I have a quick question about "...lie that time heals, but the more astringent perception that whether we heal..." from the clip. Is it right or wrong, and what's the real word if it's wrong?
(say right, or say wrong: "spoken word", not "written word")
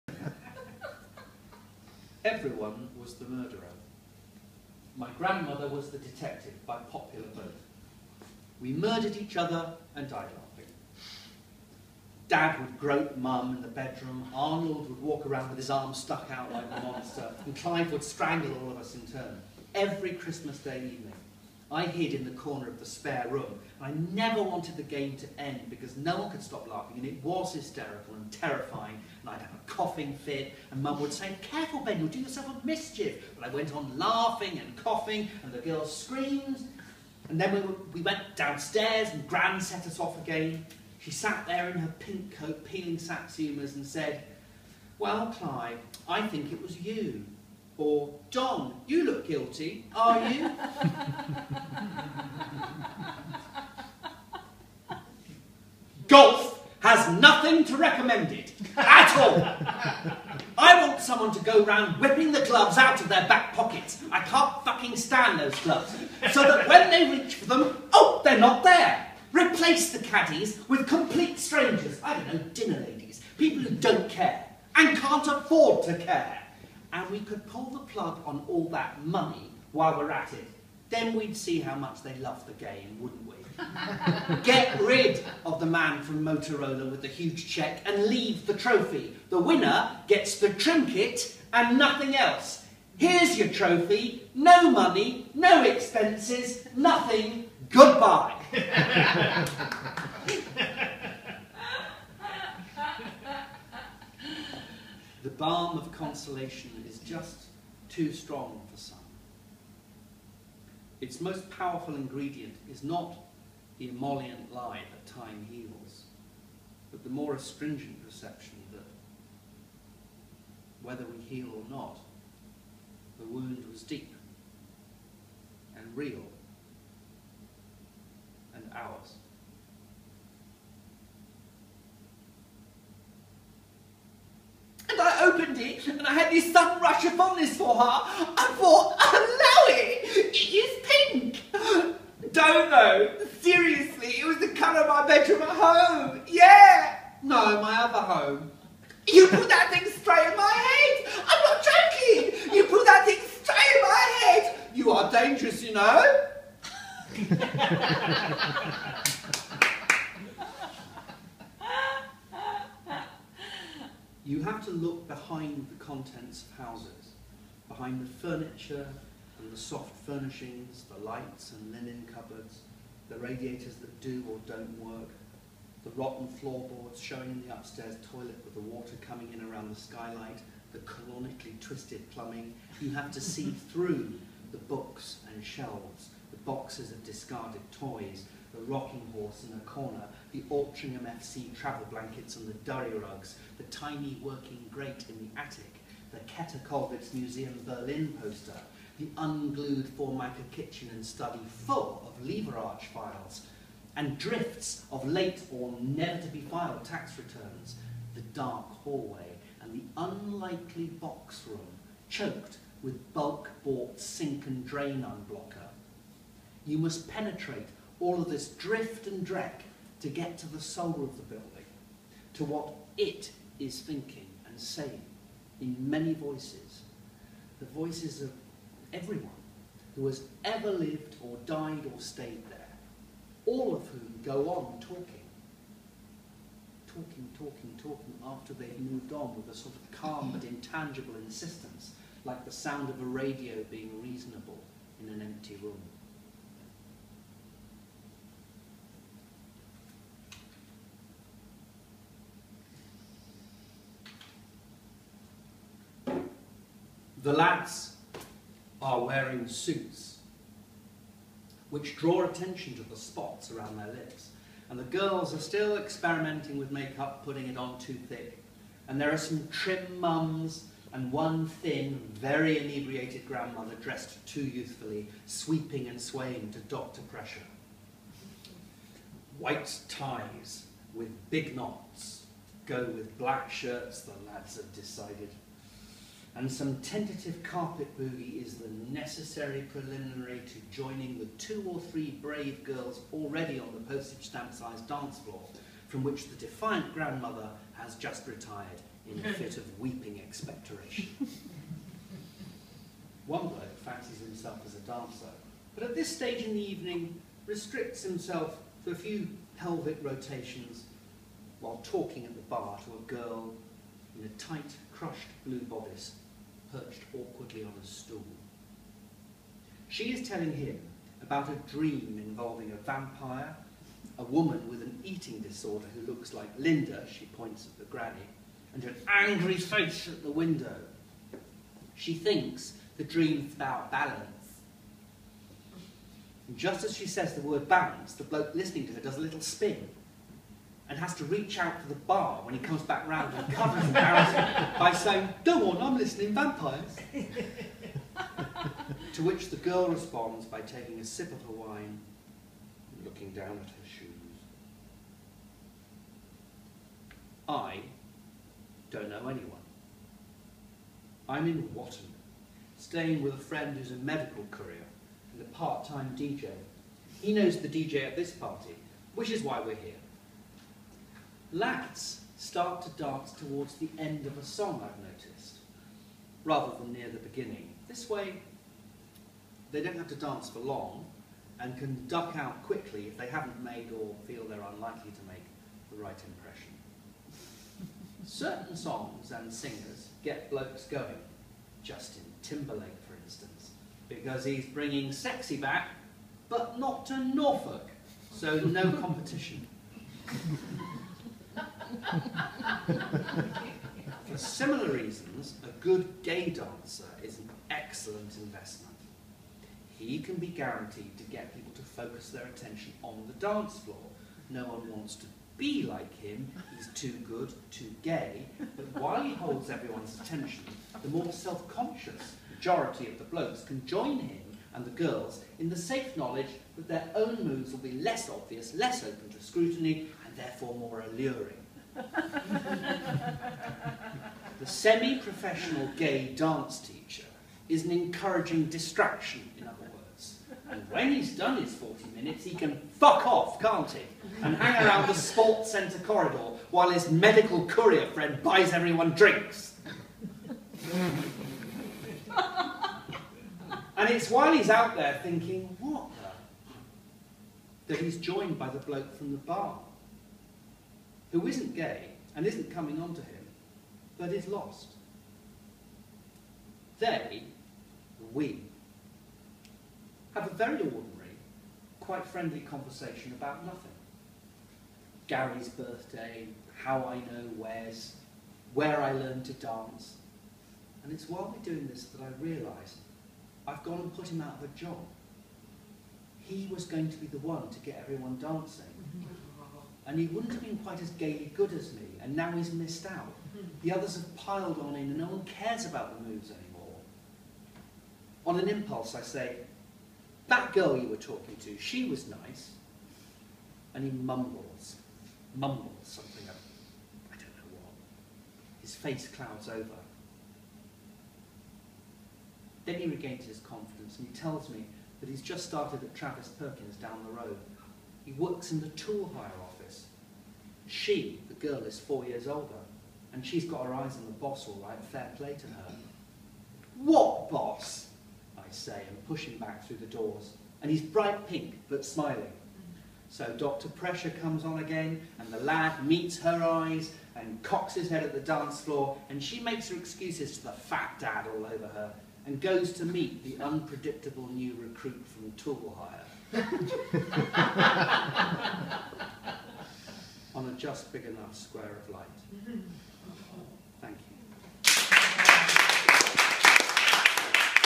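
right.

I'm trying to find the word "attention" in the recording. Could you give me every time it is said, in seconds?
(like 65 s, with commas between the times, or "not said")
262 s, 412 s, 420 s.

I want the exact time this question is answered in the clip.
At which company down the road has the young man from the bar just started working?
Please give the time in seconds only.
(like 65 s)
516 s.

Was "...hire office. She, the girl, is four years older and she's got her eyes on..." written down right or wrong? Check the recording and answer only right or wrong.
right.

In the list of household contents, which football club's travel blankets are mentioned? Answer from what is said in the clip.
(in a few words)
Altrincham FC.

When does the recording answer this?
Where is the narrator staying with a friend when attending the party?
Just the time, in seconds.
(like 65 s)
361 s.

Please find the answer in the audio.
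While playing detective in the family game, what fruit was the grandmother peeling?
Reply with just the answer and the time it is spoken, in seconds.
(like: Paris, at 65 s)
Satsumas, at 42 s.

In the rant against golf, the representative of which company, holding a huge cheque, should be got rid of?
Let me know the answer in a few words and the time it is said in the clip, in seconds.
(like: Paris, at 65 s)
Motorola, at 86 s.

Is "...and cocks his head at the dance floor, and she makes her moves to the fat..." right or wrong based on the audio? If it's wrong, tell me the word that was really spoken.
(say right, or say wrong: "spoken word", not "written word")
wrong: "excuses", not "moves".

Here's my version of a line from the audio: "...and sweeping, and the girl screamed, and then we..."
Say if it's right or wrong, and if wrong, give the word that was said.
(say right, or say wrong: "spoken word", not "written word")
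wrong: "coughing", not "sweeping".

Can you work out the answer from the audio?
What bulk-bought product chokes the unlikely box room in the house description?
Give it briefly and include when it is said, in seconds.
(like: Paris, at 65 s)
Sink and drain unblocker, at 213 s.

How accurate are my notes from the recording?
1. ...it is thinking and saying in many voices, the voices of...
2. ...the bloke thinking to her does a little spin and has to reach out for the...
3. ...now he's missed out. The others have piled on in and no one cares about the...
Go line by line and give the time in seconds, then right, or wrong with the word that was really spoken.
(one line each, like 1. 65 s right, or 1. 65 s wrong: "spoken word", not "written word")
1. 222 s right
2. 338 s wrong: "listening", not "thinking"
3. 492 s right.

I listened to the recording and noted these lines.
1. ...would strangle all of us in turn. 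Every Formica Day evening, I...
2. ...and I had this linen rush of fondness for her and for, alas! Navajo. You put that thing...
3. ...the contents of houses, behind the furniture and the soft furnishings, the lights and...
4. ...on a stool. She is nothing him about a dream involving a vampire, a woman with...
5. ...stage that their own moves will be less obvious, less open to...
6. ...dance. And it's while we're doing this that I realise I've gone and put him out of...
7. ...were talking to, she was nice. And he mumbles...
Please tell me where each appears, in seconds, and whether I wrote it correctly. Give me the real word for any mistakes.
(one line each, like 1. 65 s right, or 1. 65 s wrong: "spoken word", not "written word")
1. 17 s wrong: "Christmas", not "Formica"
2. 135 s wrong: "sudden", not "linen"
3. 165 s right
4. 317 s wrong: "telling", not "nothing"
5. 426 s wrong: "knowledge", not "stage"
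6. 479 s right
7. 501 s right.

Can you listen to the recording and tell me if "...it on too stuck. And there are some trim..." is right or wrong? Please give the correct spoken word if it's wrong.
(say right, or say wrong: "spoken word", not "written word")
wrong: "thick", not "stuck".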